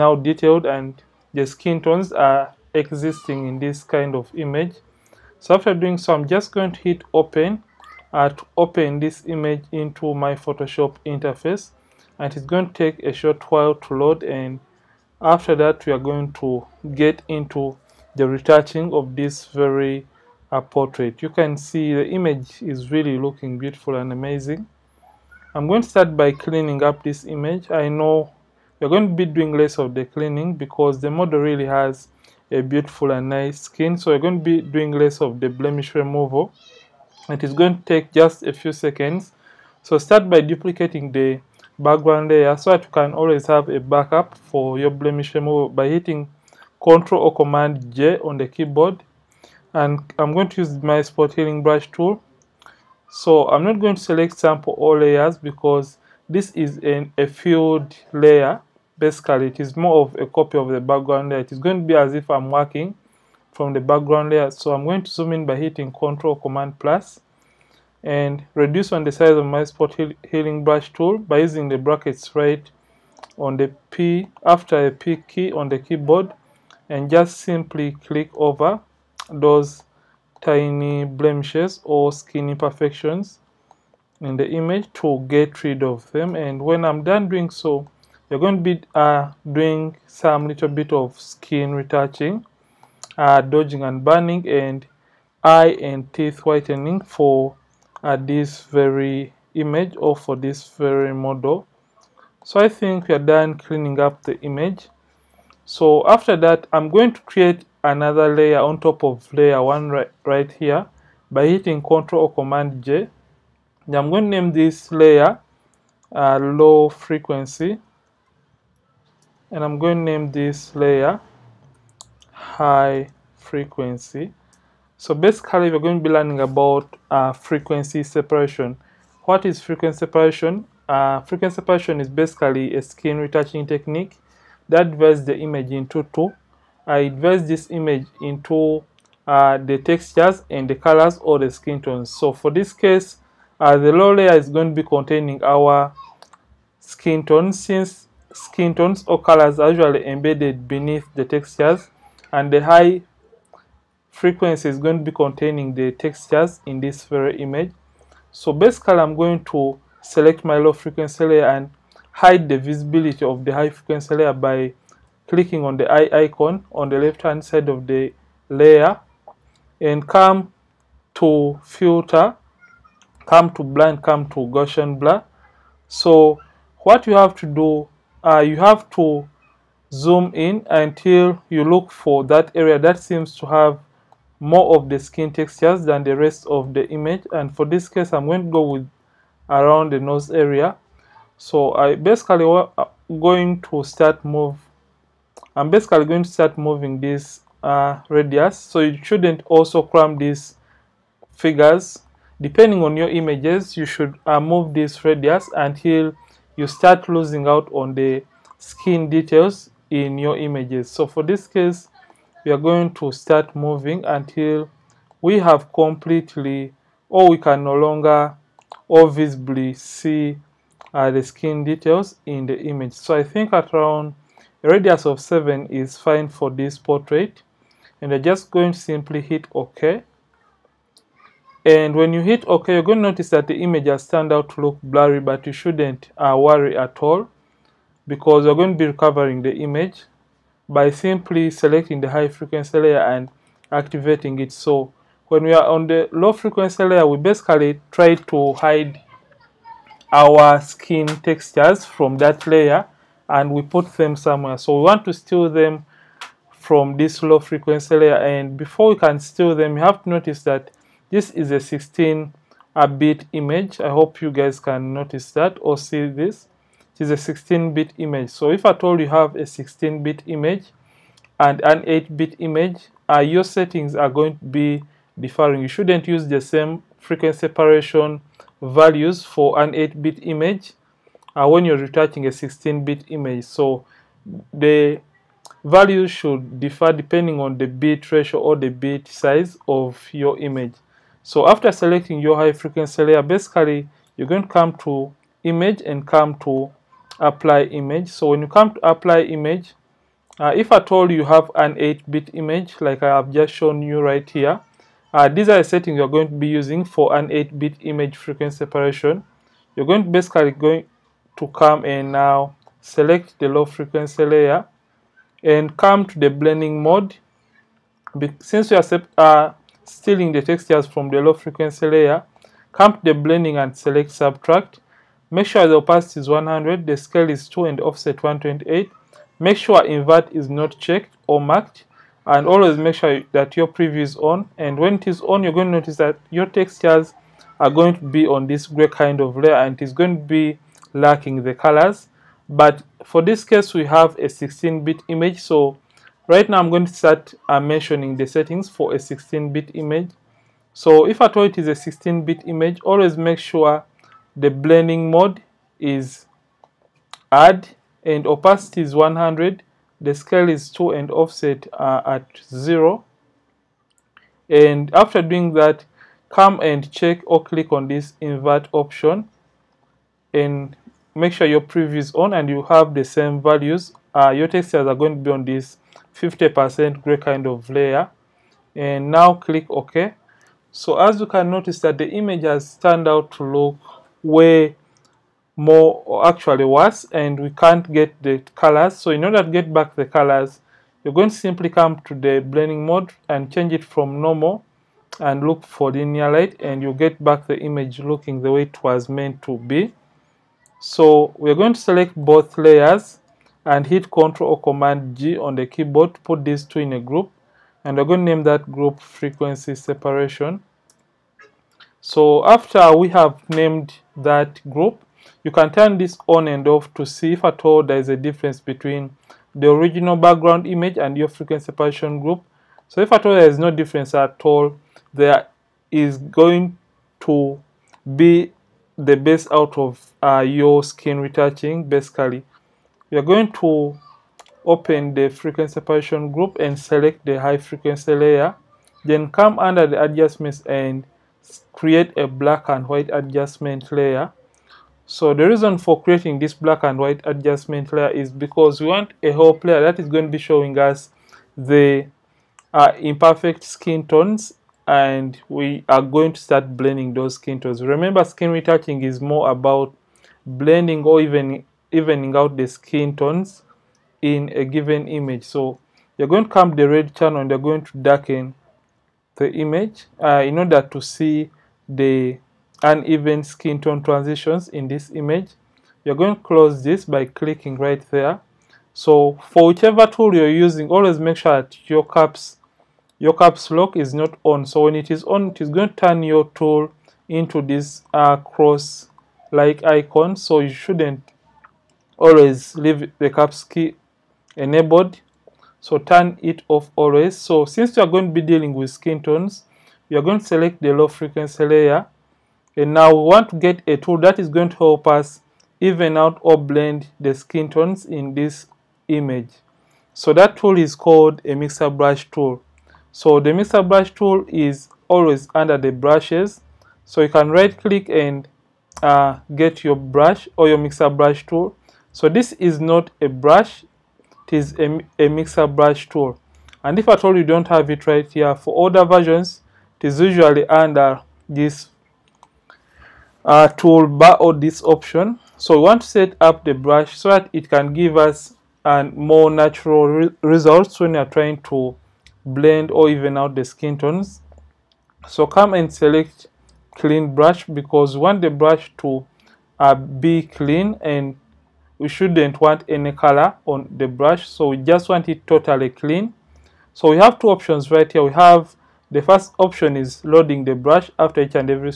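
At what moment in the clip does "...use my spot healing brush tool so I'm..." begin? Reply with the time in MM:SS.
00:50.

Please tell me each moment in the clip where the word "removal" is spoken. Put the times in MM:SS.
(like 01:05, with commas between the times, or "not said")
00:35, 00:45.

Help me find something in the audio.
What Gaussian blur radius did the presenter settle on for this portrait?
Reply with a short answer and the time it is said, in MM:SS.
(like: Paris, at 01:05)
7, at 03:45.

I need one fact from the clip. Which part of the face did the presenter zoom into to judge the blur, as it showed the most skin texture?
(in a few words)
Nose area.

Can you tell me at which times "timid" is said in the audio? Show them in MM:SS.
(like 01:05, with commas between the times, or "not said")
not said.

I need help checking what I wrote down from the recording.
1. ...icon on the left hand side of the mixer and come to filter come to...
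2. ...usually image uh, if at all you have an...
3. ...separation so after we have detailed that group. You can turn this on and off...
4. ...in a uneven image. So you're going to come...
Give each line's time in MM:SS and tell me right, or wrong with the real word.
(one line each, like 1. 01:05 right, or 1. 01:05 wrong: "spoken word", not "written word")
1. 02:46 wrong: "layer", not "mixer"
2. 04:58 wrong: "apply", not "usually"
3. 06:49 wrong: "named", not "detailed"
4. 07:44 wrong: "given", not "uneven".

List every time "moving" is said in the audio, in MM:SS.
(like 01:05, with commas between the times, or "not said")
03:16, 03:33.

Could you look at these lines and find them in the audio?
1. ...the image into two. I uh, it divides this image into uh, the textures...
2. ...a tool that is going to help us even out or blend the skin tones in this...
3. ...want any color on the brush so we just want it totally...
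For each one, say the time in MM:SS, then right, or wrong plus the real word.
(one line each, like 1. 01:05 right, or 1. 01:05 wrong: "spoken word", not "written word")
1. 02:15 right
2. 08:23 right
3. 09:12 right.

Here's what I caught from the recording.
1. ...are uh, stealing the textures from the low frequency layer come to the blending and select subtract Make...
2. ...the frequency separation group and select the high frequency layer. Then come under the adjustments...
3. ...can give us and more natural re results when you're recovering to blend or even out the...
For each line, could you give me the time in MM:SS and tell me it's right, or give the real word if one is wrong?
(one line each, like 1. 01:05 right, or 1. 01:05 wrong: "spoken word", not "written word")
1. 05:18 right
2. 07:15 right
3. 08:57 wrong: "trying", not "recovering".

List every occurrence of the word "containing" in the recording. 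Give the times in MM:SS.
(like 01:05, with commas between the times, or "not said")
02:24, 02:35.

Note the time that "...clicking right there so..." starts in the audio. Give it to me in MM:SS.
07:57.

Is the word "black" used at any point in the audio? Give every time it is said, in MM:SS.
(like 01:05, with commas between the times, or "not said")
07:22, 07:26.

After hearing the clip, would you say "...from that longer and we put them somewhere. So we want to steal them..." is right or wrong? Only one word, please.
wrong.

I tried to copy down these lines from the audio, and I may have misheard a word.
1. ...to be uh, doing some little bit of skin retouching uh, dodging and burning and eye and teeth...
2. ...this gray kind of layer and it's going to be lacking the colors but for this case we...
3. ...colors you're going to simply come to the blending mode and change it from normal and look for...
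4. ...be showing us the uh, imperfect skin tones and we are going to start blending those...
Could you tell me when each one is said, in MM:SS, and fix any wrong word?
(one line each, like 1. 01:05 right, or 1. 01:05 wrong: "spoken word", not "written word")
1. 01:28 right
2. 05:38 right
3. 06:30 right
4. 07:30 right.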